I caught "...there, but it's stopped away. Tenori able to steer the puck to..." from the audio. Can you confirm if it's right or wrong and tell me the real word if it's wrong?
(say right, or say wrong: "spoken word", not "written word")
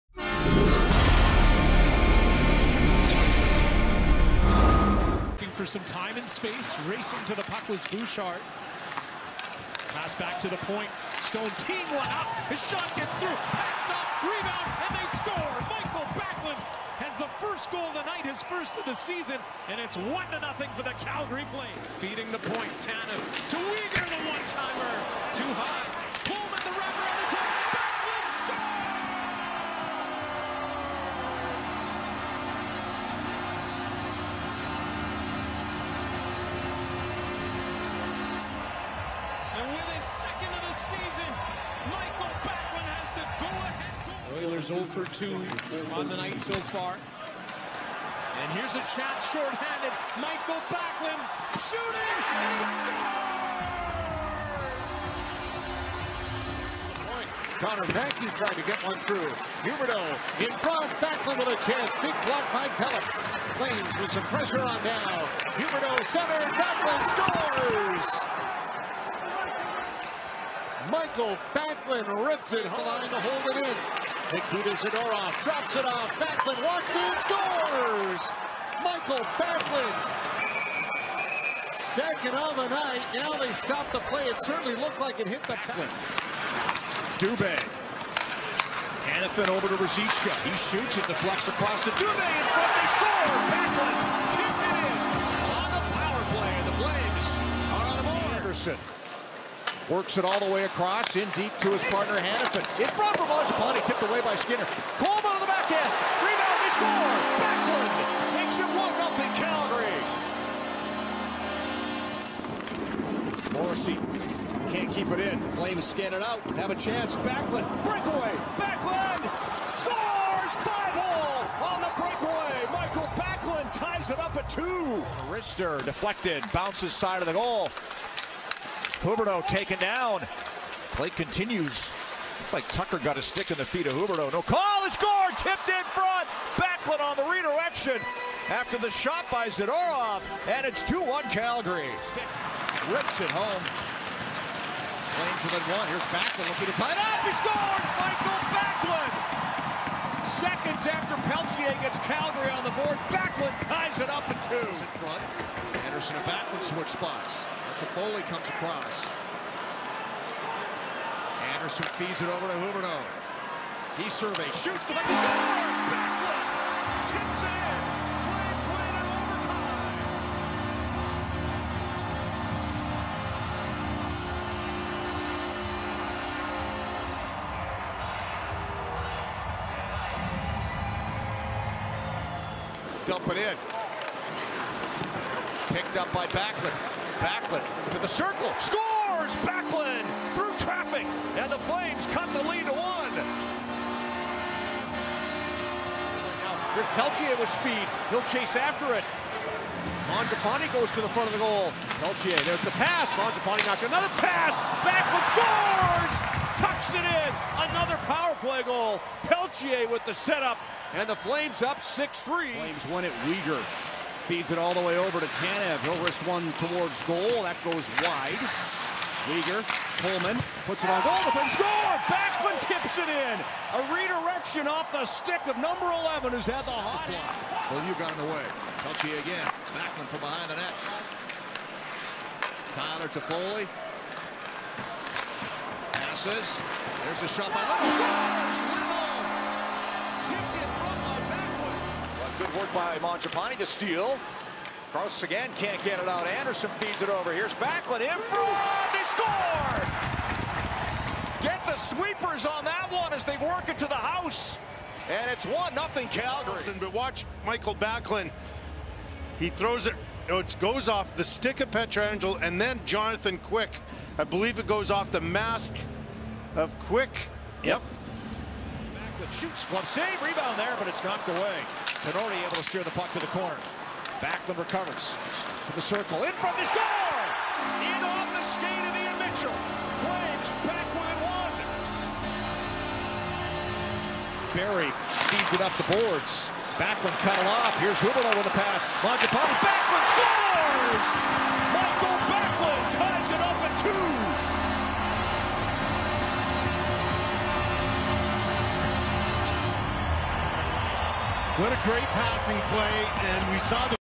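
wrong: "knocked", not "stopped".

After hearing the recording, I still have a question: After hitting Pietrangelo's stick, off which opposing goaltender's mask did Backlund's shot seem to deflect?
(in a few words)
Jonathan Quick.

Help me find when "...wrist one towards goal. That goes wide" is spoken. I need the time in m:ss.
3:36.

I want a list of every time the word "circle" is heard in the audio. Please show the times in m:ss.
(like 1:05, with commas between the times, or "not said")
3:08, 4:35.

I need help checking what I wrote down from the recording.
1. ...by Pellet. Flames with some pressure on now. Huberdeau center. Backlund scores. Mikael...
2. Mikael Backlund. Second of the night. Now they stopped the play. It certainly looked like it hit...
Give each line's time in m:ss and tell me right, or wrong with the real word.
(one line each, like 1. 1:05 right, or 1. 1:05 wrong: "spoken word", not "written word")
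1. 1:02 right
2. 1:18 right.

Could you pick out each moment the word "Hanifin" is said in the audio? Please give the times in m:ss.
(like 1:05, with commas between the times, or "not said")
1:29, 1:42.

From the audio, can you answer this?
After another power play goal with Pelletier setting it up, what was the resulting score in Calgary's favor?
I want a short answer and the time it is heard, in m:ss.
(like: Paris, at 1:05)
6-3, at 3:31.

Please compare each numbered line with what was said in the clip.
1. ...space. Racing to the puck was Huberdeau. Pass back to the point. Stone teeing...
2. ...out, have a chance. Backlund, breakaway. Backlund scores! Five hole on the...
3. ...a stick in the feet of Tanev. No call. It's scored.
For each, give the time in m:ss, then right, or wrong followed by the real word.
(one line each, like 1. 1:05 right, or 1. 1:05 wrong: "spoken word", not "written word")
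1. 0:06 wrong: "Bouchard", not "Huberdeau"
2. 1:56 right
3. 2:13 wrong: "Huberdeau", not "Tanev".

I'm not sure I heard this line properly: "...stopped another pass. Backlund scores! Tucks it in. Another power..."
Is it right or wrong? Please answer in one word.
wrong.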